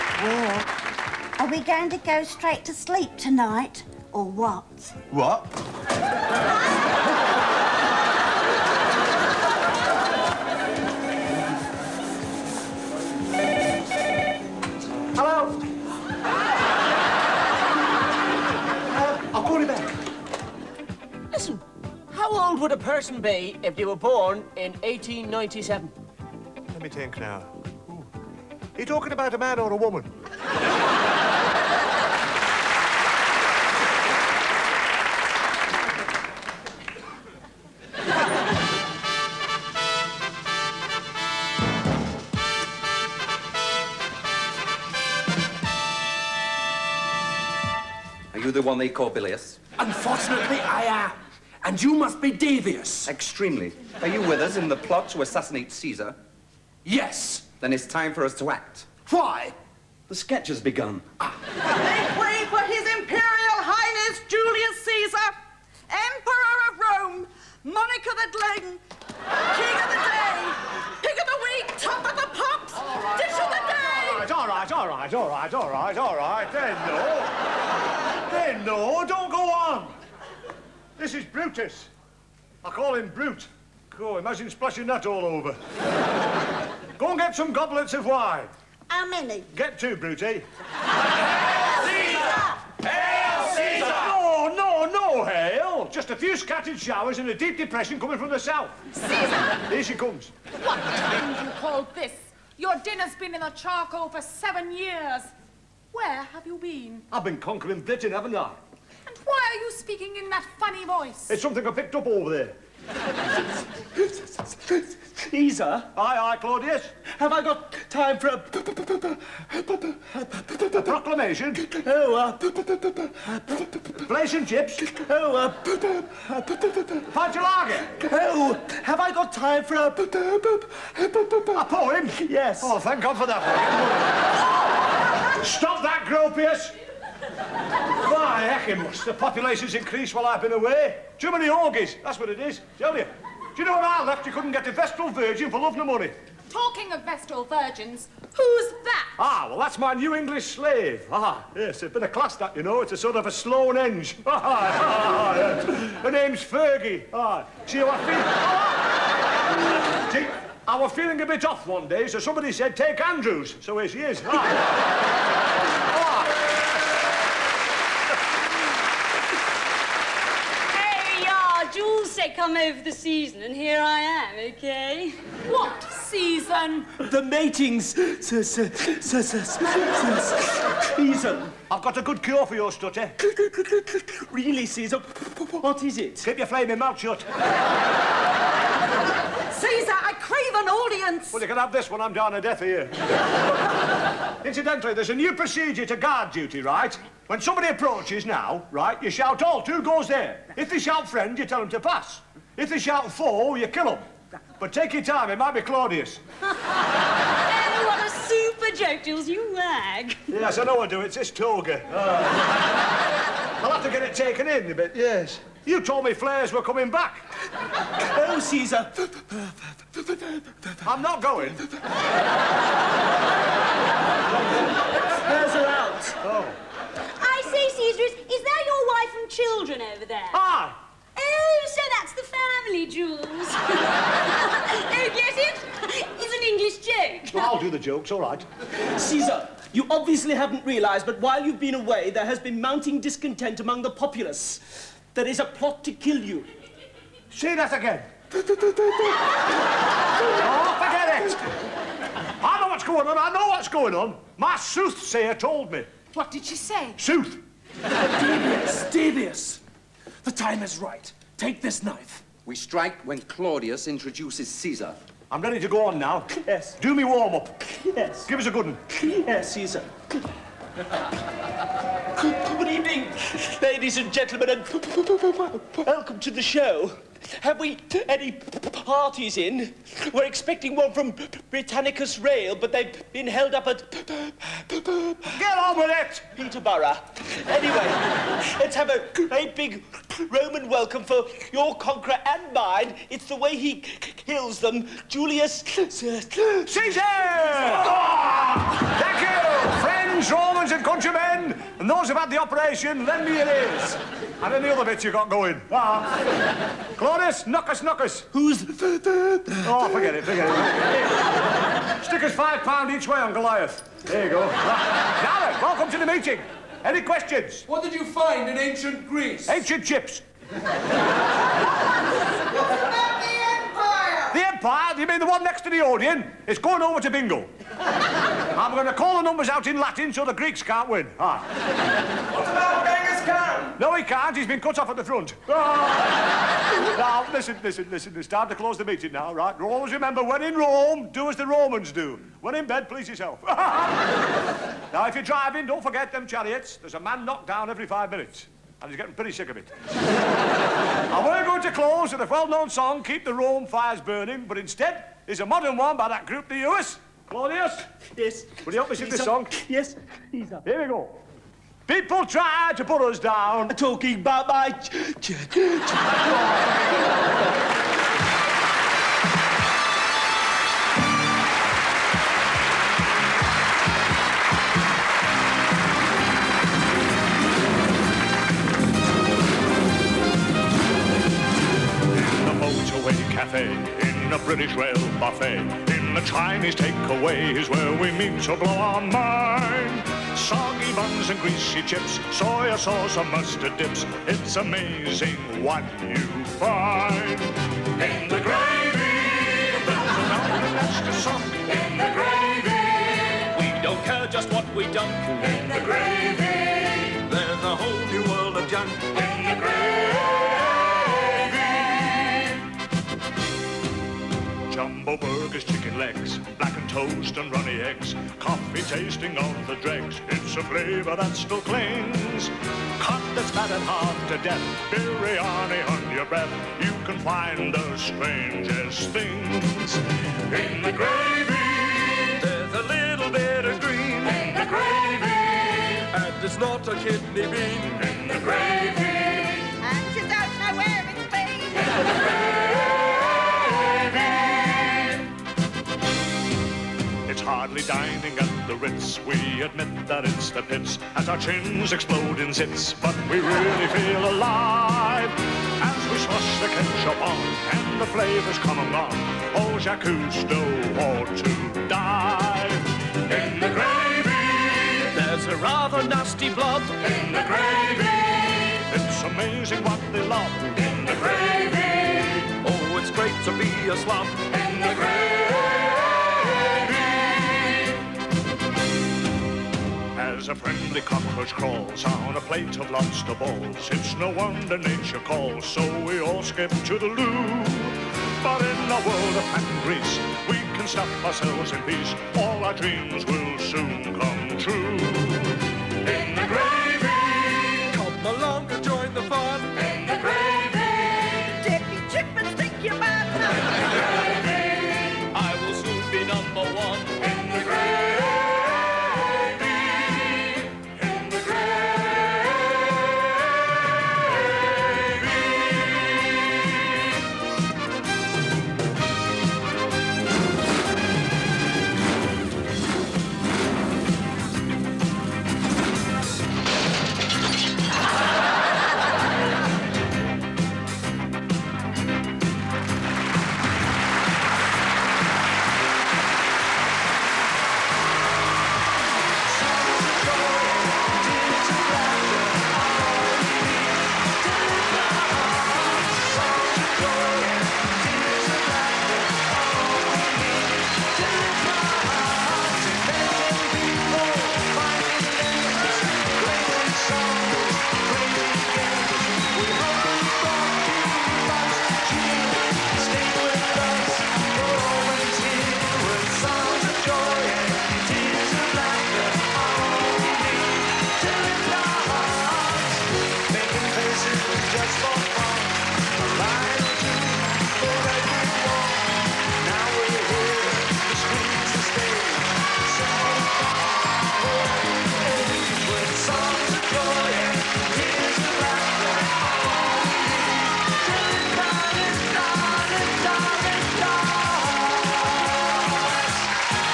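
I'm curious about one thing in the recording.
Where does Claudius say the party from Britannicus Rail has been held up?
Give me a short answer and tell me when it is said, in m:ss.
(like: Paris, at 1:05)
Peterborough, at 4:46.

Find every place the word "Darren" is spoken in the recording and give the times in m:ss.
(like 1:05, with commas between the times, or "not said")
5:14.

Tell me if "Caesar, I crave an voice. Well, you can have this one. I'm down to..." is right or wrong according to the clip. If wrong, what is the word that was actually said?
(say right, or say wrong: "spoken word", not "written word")
wrong: "audience", not "voice".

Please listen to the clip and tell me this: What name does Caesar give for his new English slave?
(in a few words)
Fergie.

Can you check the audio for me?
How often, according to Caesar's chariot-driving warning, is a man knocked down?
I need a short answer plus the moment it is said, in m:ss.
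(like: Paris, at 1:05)
every 5 minutes, at 5:47.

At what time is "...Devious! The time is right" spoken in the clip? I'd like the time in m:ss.
4:18.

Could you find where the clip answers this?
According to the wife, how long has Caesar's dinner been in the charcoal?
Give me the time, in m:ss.
1:44.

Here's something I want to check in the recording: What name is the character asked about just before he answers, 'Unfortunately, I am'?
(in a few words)
Bilius.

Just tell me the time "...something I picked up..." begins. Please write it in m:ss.
1:51.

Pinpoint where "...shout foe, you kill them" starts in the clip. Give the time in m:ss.
3:22.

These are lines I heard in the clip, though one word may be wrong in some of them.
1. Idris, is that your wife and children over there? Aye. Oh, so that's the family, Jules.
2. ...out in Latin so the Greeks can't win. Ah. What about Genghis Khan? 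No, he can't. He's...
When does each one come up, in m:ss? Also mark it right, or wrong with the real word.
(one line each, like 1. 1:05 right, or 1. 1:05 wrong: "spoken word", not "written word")
1. 3:47 right
2. 5:29 right.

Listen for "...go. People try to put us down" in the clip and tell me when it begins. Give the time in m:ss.
6:00.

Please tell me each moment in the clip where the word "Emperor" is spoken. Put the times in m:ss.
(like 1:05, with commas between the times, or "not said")
1:05.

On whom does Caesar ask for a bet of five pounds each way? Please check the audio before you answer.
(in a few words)
Goliath.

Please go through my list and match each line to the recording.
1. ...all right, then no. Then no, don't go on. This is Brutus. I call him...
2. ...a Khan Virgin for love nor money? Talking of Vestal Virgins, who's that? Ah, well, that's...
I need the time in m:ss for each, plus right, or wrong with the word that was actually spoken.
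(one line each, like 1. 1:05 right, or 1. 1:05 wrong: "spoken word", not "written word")
1. 1:16 right
2. 2:24 wrong: "Vestal", not "Khan".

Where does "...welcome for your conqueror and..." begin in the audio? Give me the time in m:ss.
4:50.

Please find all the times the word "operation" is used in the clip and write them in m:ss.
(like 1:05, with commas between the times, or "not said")
5:02.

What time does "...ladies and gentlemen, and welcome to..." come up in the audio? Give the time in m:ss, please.
4:33.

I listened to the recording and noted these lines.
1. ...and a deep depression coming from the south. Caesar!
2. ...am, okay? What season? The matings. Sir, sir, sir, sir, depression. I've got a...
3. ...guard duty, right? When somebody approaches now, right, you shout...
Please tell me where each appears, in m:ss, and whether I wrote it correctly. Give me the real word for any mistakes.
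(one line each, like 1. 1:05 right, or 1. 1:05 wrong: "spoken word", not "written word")
1. 1:37 right
2. 2:54 wrong: "season", not "depression"
3. 3:15 right.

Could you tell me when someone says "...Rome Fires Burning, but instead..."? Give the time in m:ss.
5:53.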